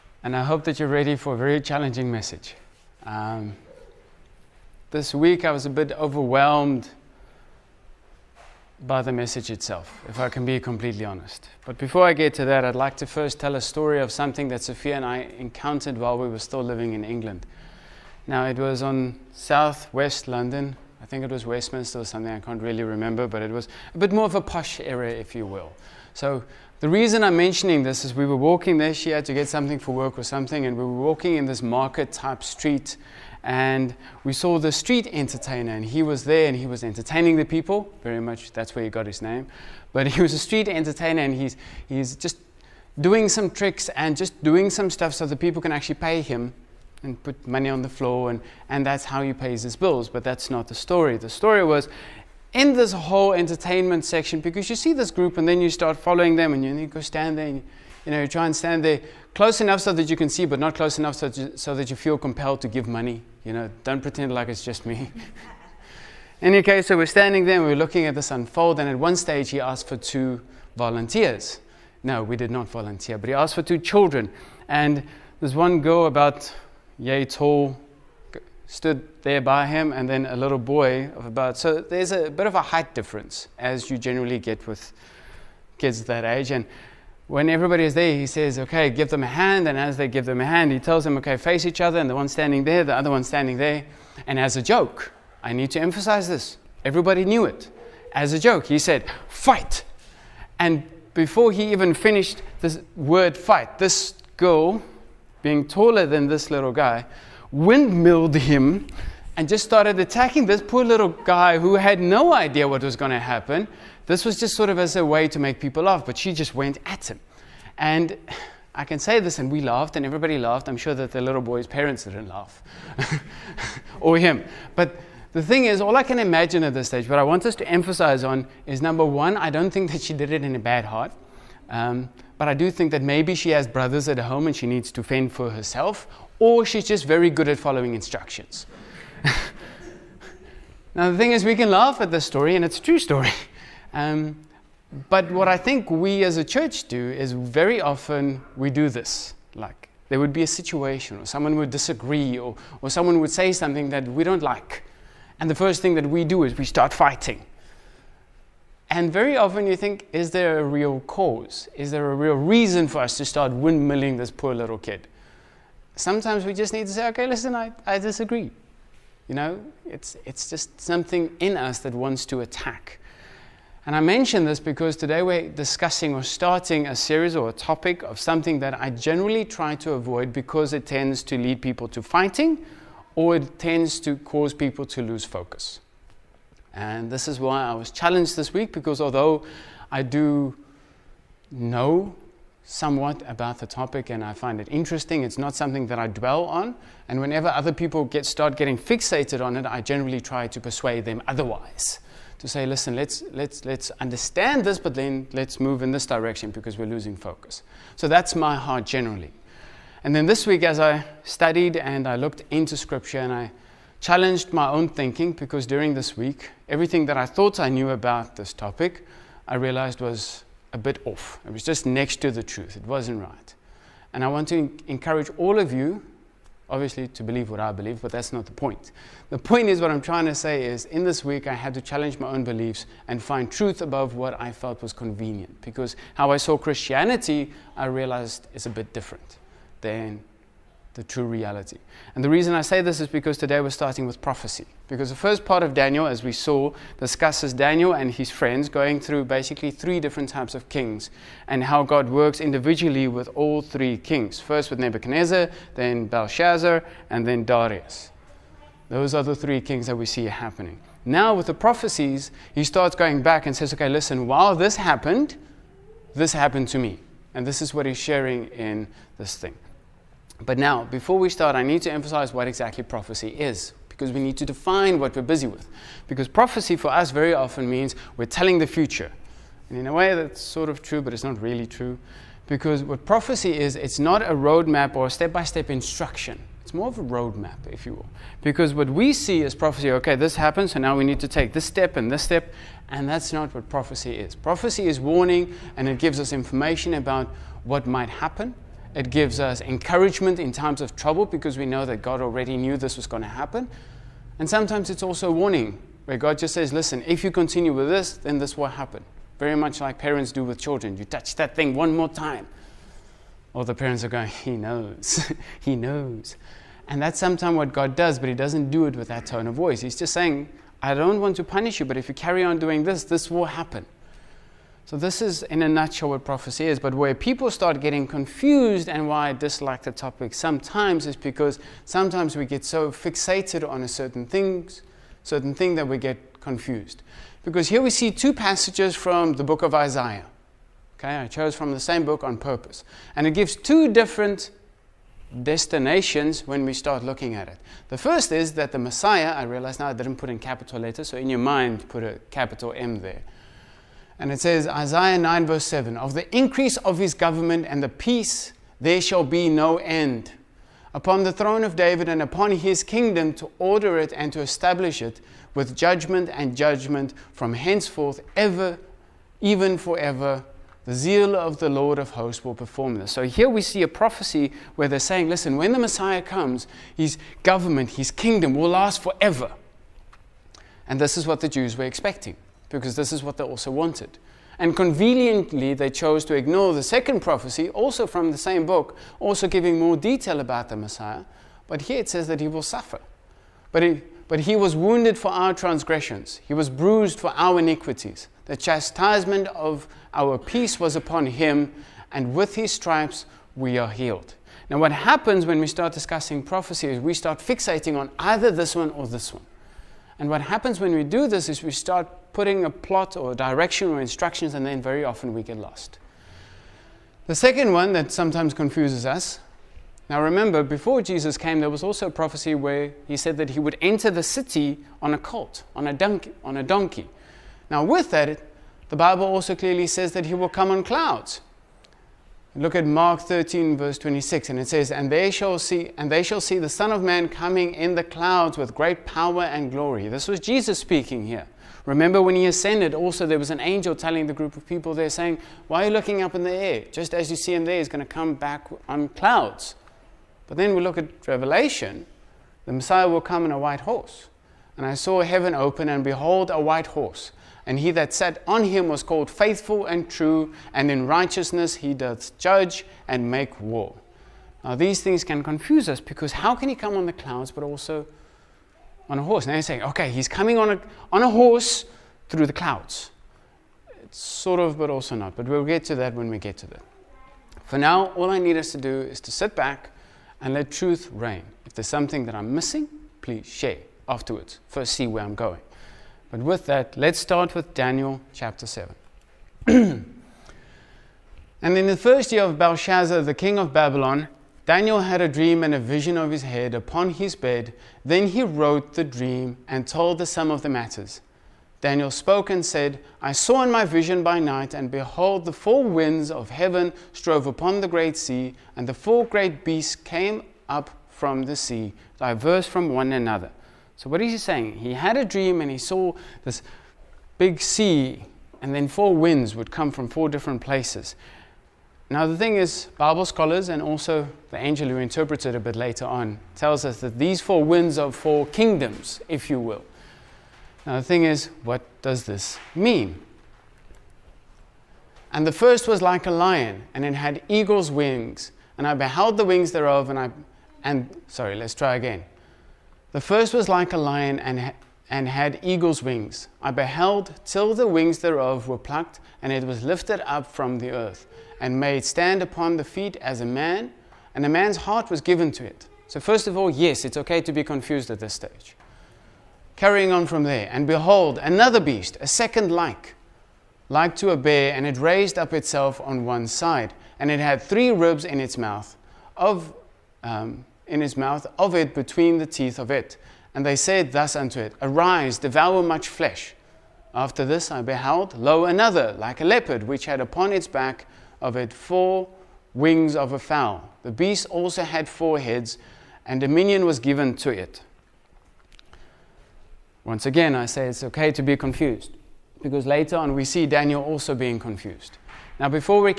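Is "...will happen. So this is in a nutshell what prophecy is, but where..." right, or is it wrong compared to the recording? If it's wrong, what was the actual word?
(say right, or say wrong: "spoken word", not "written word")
right.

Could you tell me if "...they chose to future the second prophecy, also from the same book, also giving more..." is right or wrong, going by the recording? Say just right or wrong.
wrong.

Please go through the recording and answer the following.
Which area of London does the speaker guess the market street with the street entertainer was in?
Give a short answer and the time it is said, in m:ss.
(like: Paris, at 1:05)
Westminster, at 0:21.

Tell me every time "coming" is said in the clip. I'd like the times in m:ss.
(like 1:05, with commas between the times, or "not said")
7:17, 7:50.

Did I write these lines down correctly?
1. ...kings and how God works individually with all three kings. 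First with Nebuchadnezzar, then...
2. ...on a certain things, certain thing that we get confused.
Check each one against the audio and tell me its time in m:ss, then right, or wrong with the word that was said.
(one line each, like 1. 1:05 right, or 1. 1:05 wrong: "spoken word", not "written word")
1. 4:10 right
2. 5:33 right.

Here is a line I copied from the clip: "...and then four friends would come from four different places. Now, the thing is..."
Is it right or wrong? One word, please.
wrong.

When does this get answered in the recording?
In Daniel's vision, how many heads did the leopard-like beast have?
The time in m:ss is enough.
9:45.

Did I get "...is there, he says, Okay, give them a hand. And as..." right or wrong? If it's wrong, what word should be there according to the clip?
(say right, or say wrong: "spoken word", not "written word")
right.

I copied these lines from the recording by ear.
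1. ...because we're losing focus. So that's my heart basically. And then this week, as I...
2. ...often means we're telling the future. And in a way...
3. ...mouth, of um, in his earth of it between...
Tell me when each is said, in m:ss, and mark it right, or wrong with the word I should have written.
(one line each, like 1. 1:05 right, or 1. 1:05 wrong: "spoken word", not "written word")
1. 3:26 wrong: "generally", not "basically"
2. 4:37 right
3. 9:28 wrong: "mouth", not "earth".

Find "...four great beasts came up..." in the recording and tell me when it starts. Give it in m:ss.
8:28.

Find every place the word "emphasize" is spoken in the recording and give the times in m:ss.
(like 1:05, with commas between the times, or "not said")
1:35, 2:07, 4:31.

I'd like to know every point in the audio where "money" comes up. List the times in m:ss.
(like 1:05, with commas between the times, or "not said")
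0:47, 1:02.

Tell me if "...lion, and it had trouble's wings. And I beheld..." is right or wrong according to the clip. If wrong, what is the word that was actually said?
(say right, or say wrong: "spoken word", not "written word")
wrong: "eagle", not "trouble".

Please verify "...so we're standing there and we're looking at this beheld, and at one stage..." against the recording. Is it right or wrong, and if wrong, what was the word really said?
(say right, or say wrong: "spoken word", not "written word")
wrong: "unfold", not "beheld".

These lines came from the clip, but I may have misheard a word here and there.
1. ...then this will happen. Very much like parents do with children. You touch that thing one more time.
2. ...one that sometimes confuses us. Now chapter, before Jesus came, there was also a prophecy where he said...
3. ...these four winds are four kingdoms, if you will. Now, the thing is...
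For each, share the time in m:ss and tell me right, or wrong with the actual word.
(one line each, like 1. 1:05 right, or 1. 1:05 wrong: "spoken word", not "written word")
1. 5:08 right
2. 6:57 wrong: "remember", not "chapter"
3. 8:47 right.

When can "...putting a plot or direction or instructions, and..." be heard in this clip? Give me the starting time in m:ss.
6:52.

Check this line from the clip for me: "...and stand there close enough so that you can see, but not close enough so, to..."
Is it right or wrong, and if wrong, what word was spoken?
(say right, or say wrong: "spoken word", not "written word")
right.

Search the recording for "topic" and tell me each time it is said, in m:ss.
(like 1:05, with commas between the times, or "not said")
2:57, 3:13, 3:38, 5:29.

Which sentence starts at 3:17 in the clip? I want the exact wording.
And whenever other people get, start getting fixated on it, I generally try to persuade them otherwise.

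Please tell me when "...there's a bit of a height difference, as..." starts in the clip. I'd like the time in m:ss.
1:21.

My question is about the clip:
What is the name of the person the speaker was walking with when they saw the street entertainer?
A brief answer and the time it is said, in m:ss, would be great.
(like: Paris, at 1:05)
Sophia, at 0:14.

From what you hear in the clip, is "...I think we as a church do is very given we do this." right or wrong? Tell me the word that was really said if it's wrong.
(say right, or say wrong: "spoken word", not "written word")
wrong: "often", not "given".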